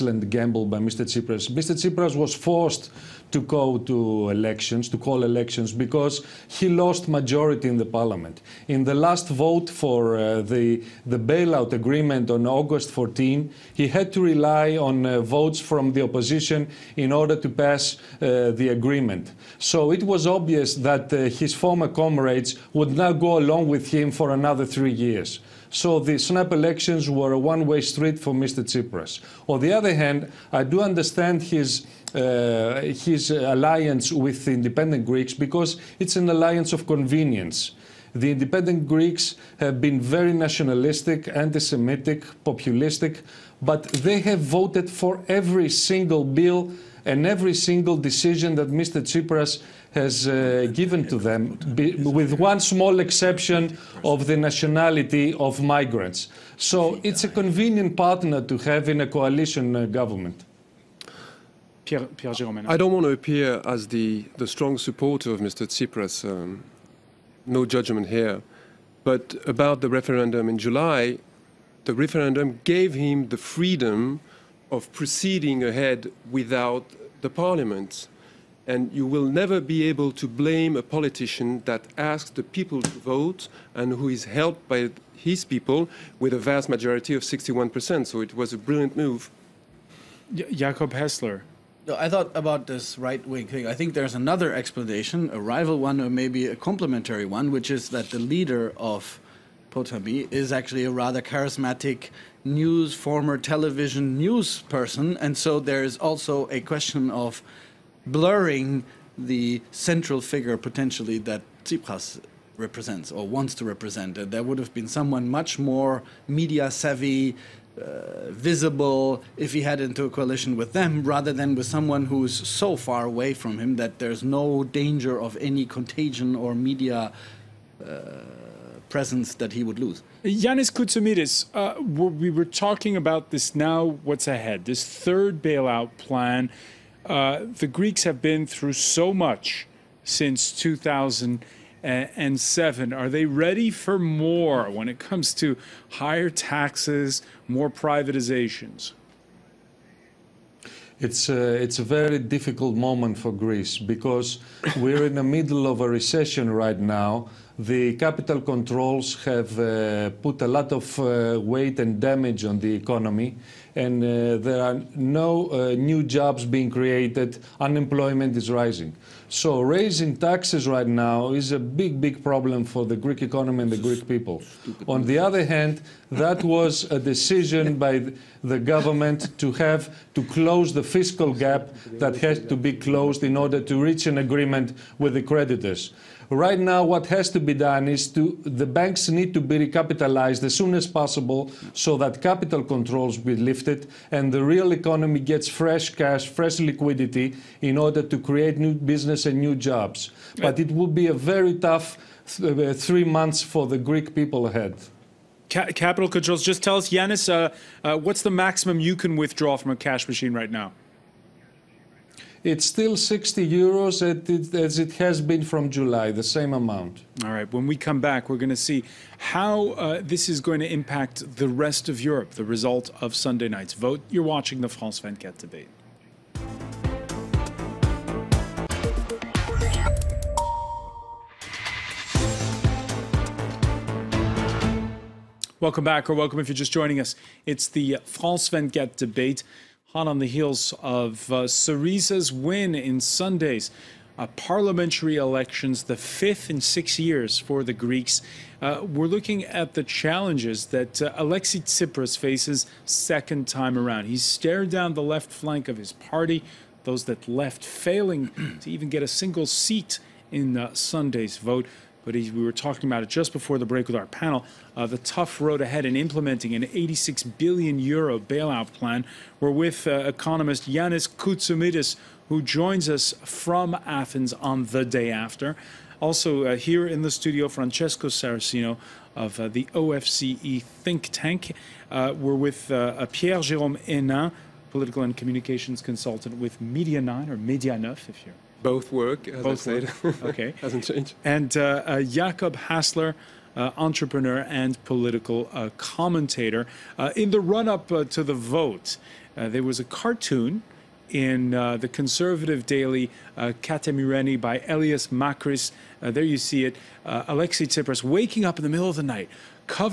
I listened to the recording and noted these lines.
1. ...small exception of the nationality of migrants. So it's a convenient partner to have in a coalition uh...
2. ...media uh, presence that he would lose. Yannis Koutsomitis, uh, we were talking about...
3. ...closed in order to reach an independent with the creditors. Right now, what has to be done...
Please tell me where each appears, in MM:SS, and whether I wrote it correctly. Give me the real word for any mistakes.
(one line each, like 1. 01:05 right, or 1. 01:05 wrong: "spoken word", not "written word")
1. 00:52 right
2. 02:06 right
3. 03:02 wrong: "agreement", not "independent".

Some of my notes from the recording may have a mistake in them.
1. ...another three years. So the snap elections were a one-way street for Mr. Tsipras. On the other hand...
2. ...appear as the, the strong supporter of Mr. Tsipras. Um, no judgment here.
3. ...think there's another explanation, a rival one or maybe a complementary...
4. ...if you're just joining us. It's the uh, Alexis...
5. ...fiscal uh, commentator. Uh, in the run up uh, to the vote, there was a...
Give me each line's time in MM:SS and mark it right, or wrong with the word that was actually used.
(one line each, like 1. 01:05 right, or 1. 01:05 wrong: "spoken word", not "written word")
1. 00:24 right
2. 01:03 right
3. 01:33 right
4. 03:56 wrong: "France", not "Alexis"
5. 04:54 wrong: "political", not "fiscal".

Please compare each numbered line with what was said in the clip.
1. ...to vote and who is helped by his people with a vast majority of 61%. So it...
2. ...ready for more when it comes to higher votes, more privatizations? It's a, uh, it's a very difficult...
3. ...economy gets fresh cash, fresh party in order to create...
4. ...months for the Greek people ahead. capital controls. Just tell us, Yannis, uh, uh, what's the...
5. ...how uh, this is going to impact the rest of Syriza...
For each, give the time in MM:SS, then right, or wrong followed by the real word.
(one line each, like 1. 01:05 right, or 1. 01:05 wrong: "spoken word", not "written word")
1. 01:22 right
2. 02:23 wrong: "taxes", not "votes"
3. 03:14 wrong: "liquidity", not "party"
4. 03:23 right
5. 03:39 wrong: "Europe", not "Syriza".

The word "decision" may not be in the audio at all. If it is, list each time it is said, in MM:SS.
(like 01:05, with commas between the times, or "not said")
00:47, 02:56.